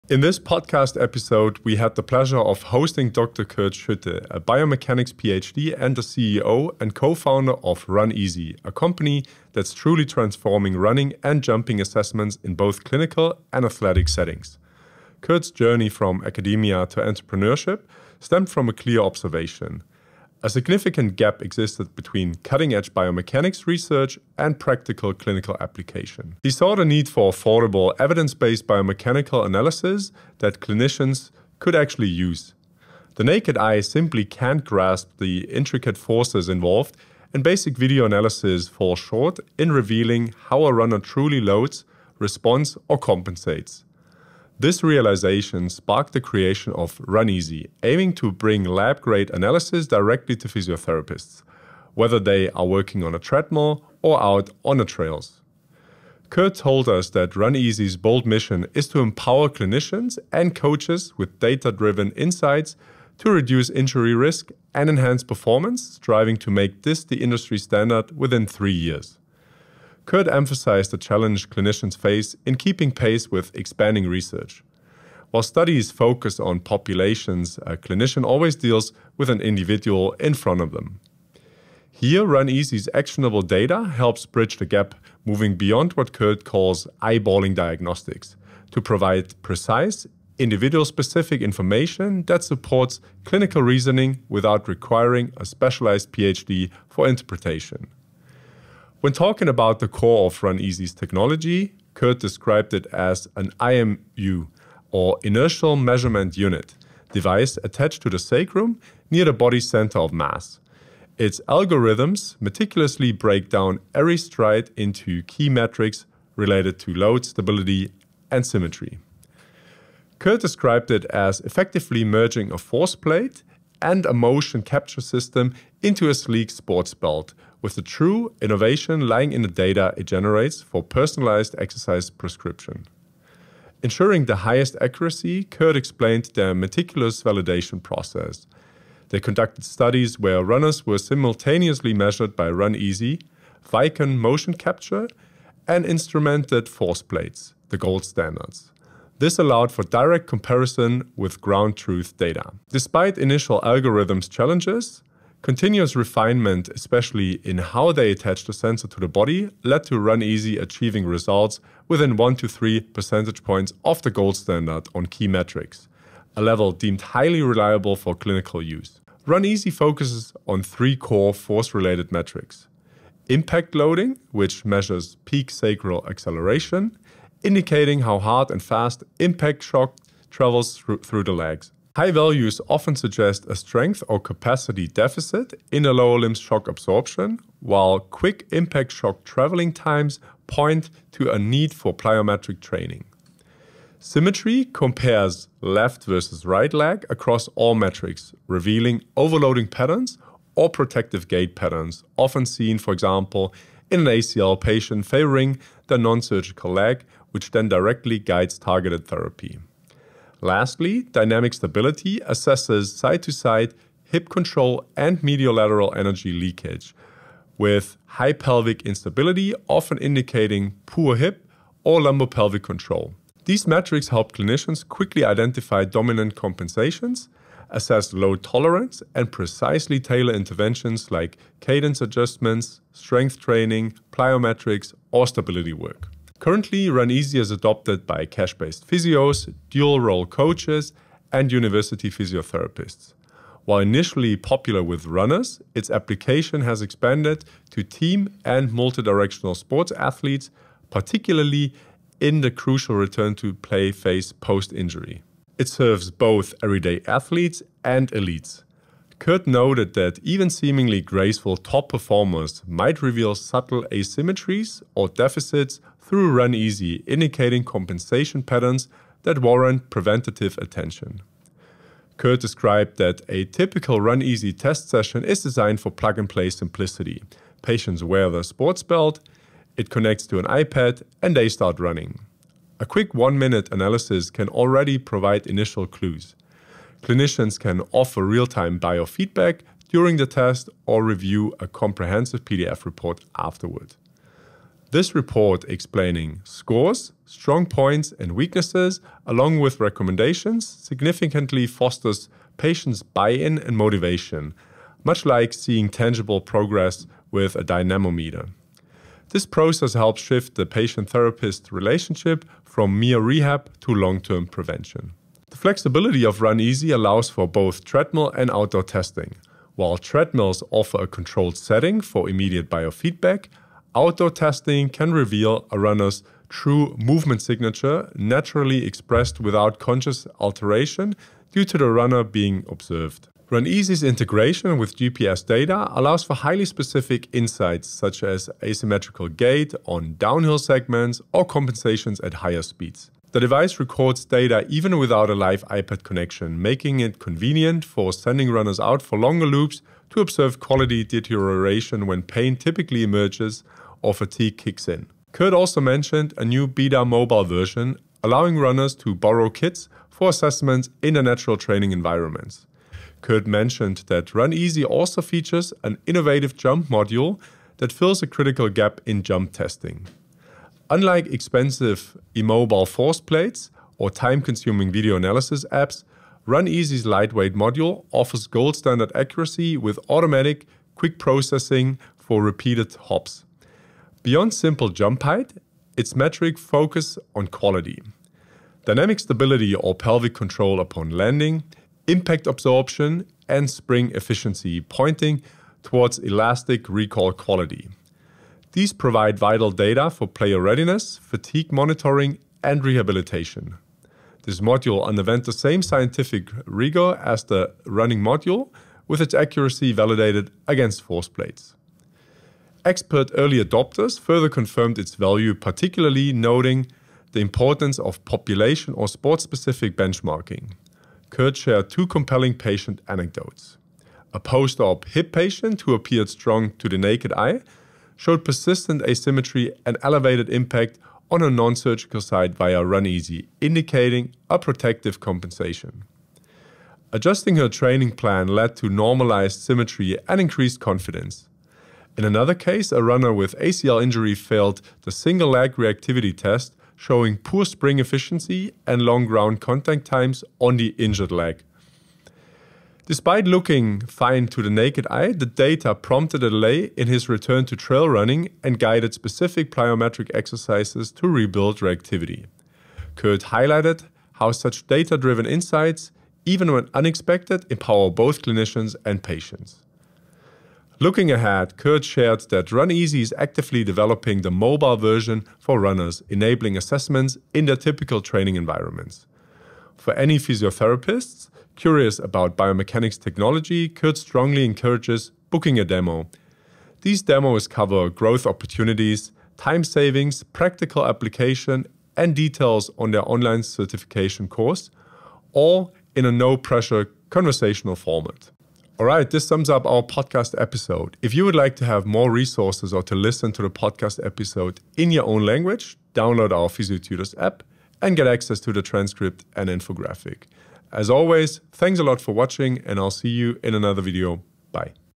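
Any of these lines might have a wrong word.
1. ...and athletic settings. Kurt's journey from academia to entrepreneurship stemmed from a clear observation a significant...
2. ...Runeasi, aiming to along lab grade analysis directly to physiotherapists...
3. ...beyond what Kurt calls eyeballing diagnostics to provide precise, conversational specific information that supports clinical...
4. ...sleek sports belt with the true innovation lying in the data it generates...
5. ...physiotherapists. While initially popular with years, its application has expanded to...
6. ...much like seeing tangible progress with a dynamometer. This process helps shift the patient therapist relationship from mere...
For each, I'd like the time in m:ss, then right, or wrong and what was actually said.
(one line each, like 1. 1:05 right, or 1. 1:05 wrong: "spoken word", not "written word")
1. 0:13 right
2. 0:47 wrong: "bring", not "along"
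3. 1:25 wrong: "individual", not "conversational"
4. 2:06 right
5. 4:02 wrong: "runners", not "years"
6. 5:05 right.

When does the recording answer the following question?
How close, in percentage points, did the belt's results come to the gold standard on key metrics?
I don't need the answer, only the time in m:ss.
2:42.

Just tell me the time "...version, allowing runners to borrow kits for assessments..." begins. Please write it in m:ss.
5:57.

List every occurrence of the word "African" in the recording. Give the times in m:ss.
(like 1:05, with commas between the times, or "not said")
not said.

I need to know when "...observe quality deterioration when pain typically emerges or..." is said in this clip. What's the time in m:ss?
5:50.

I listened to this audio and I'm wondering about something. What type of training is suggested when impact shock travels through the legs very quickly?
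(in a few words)
plyometric training.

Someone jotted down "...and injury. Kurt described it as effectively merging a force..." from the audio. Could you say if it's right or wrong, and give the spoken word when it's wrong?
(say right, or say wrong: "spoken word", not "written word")
wrong: "symmetry", not "injury".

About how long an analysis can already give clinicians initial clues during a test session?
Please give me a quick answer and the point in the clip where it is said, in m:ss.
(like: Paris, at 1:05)
one minute, at 4:43.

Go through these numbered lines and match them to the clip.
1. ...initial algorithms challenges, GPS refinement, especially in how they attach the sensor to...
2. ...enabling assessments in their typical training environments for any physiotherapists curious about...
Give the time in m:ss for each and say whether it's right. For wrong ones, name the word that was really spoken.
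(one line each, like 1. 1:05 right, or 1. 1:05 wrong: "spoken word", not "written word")
1. 2:33 wrong: "Continuous", not "GPS"
2. 7:56 right.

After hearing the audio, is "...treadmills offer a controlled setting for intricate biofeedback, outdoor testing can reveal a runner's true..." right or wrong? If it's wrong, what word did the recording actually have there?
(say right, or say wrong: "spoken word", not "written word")
wrong: "immediate", not "intricate".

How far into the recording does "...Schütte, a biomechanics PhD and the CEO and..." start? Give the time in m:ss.
0:03.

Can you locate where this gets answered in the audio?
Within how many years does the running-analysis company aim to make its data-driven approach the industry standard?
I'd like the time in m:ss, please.
1:08.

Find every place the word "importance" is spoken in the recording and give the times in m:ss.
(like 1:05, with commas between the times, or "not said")
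6:57.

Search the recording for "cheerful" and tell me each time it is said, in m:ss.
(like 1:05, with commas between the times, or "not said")
not said.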